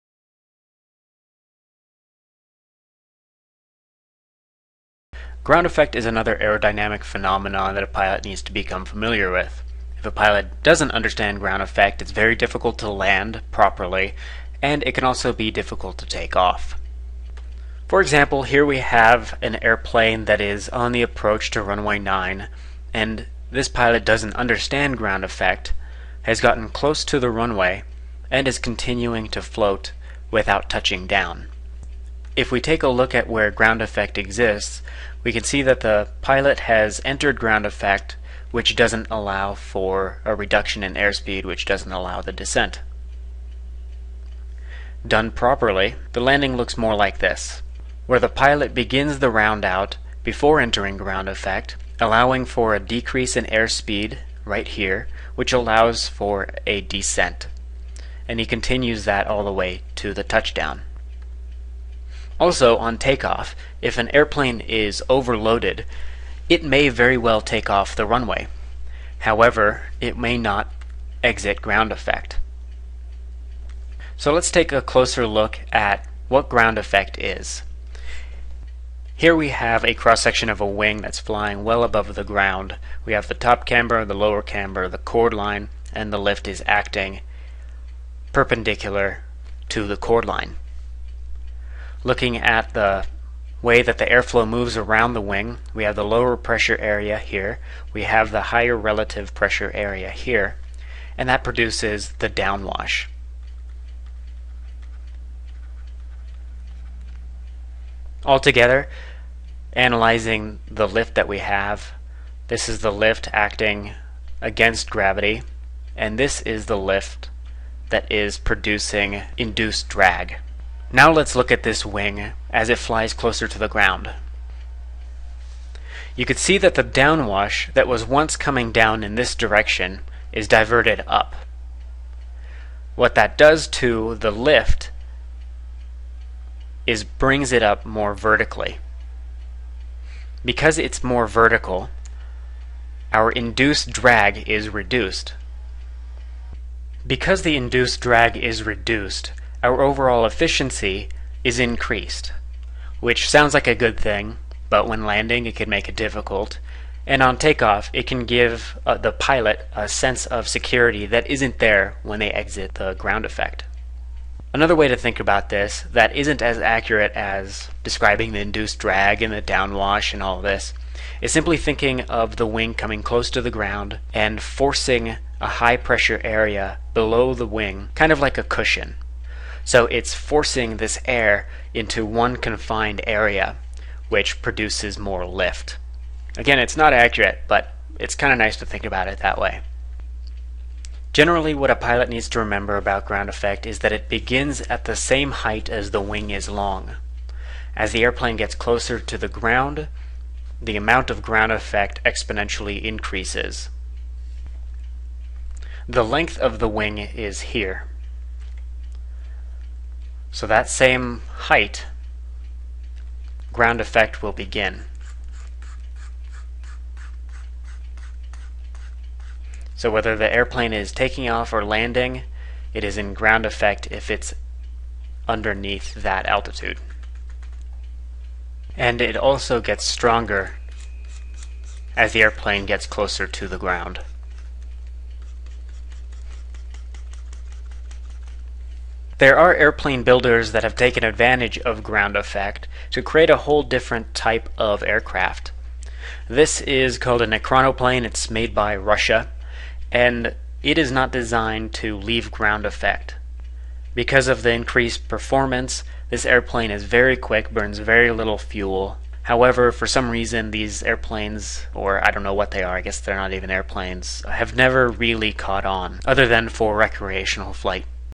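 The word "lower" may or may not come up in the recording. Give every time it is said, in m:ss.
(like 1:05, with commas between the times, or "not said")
1:24, 1:36.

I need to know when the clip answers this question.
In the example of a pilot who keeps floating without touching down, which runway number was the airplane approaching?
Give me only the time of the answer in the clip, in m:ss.
0:21.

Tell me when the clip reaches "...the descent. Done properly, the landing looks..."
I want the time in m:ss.
0:42.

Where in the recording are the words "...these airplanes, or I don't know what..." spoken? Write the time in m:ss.
4:20.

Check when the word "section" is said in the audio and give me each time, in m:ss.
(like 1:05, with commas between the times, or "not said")
1:19.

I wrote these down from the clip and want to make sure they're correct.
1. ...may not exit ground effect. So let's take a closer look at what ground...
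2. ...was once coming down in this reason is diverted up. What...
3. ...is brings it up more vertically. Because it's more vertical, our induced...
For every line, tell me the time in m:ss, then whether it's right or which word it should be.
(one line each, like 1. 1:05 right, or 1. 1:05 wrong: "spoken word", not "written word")
1. 1:10 right
2. 2:07 wrong: "direction", not "reason"
3. 2:16 right.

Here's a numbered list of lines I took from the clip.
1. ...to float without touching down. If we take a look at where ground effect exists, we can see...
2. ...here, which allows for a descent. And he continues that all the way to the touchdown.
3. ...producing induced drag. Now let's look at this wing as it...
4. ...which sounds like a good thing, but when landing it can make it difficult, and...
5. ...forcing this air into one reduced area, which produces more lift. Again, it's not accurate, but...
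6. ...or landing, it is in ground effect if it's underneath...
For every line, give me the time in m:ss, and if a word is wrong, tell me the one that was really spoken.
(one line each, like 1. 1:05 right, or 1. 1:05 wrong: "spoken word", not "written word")
1. 0:29 right
2. 0:54 right
3. 1:58 right
4. 2:32 right
5. 3:00 wrong: "confined", not "reduced"
6. 3:41 right.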